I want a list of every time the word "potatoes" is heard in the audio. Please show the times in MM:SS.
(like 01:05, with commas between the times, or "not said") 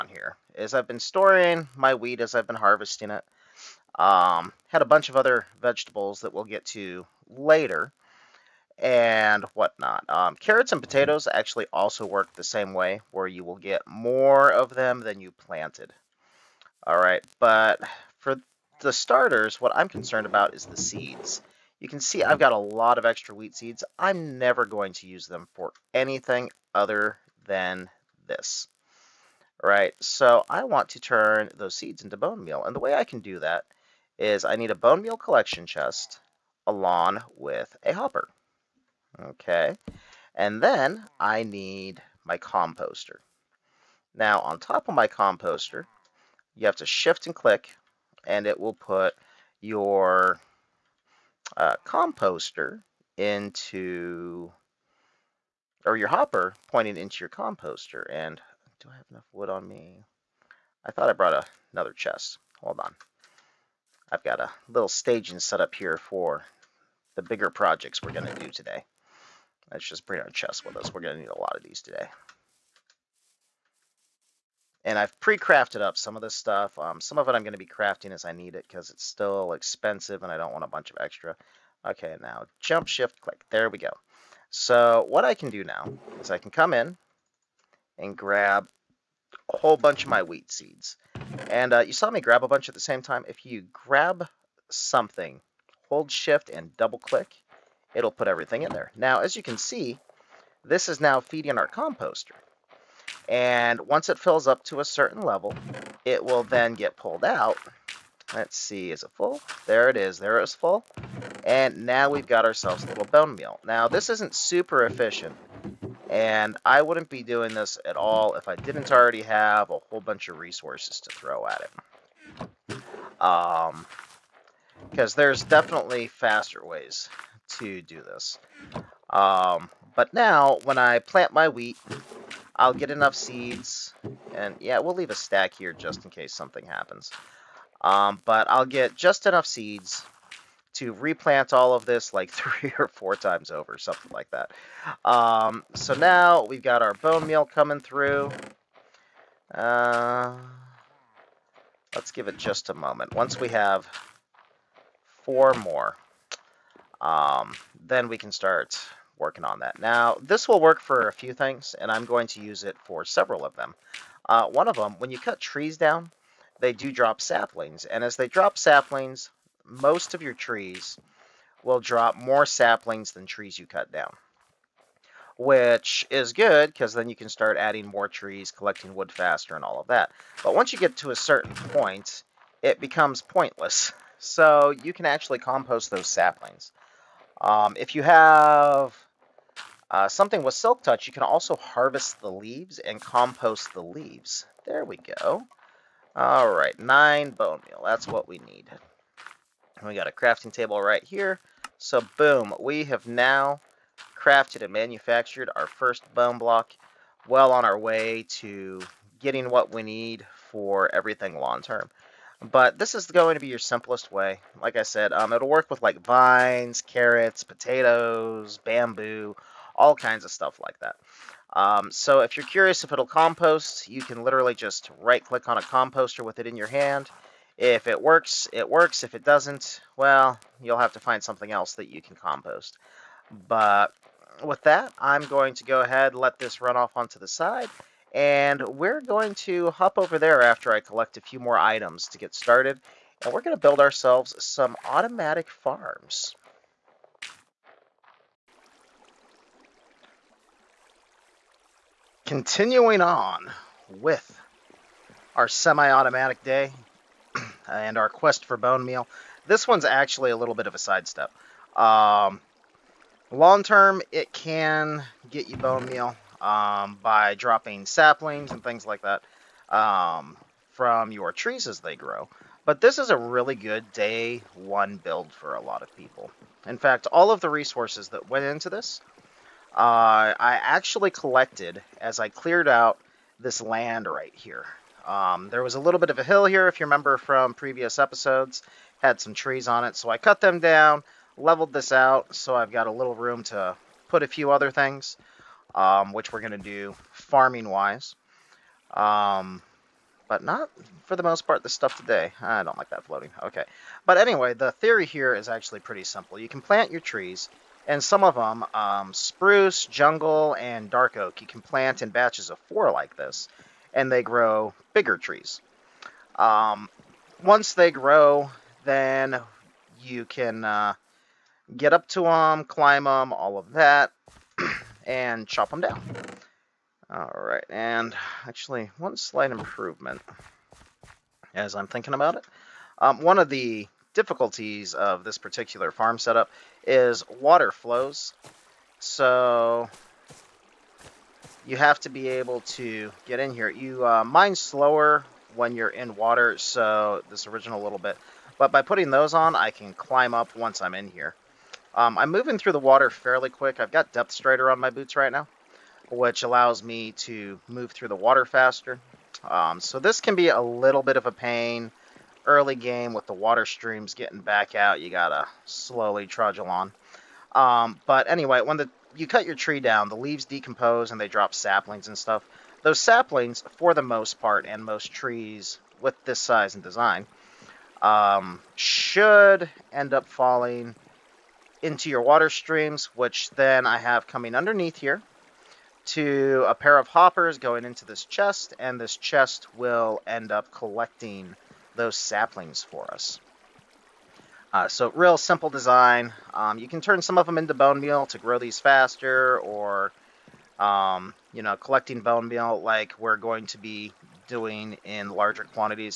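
00:10, 03:37.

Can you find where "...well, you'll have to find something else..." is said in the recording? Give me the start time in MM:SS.
03:49.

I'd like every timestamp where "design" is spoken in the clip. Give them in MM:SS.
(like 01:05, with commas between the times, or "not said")
06:16, 06:35.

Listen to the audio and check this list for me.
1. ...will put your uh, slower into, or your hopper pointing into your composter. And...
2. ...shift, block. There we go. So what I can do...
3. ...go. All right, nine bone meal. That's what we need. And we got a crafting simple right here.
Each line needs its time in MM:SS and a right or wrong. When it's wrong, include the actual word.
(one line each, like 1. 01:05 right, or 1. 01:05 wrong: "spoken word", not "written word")
1. 00:48 wrong: "composter", not "slower"
2. 01:22 wrong: "click", not "block"
3. 03:15 wrong: "table", not "simple".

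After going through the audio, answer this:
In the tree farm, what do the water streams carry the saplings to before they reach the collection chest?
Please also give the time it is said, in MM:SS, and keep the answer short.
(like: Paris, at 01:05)
A pair of hoppers, at 06:26.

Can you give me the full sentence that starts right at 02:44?
Uh, one of them, when you cut trees down, they do drop saplings.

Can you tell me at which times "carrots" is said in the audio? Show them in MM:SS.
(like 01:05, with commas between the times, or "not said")
00:10, 03:36.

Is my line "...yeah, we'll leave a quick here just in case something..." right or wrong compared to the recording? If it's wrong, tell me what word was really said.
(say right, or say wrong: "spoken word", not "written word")
wrong: "stack", not "quick".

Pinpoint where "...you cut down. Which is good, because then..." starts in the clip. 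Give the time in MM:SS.
02:53.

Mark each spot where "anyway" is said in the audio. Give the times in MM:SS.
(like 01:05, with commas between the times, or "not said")
05:04, 06:08.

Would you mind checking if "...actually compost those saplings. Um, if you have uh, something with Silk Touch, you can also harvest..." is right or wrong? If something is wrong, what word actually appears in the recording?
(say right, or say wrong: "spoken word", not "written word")
right.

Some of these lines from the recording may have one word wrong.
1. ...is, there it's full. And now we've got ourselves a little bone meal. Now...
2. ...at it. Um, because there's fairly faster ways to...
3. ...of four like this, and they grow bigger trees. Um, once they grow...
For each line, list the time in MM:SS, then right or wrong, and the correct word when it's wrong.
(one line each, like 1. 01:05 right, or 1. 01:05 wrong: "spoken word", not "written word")
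1. 01:49 right
2. 02:01 wrong: "definitely", not "fairly"
3. 05:12 right.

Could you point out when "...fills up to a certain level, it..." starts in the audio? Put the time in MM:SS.
01:44.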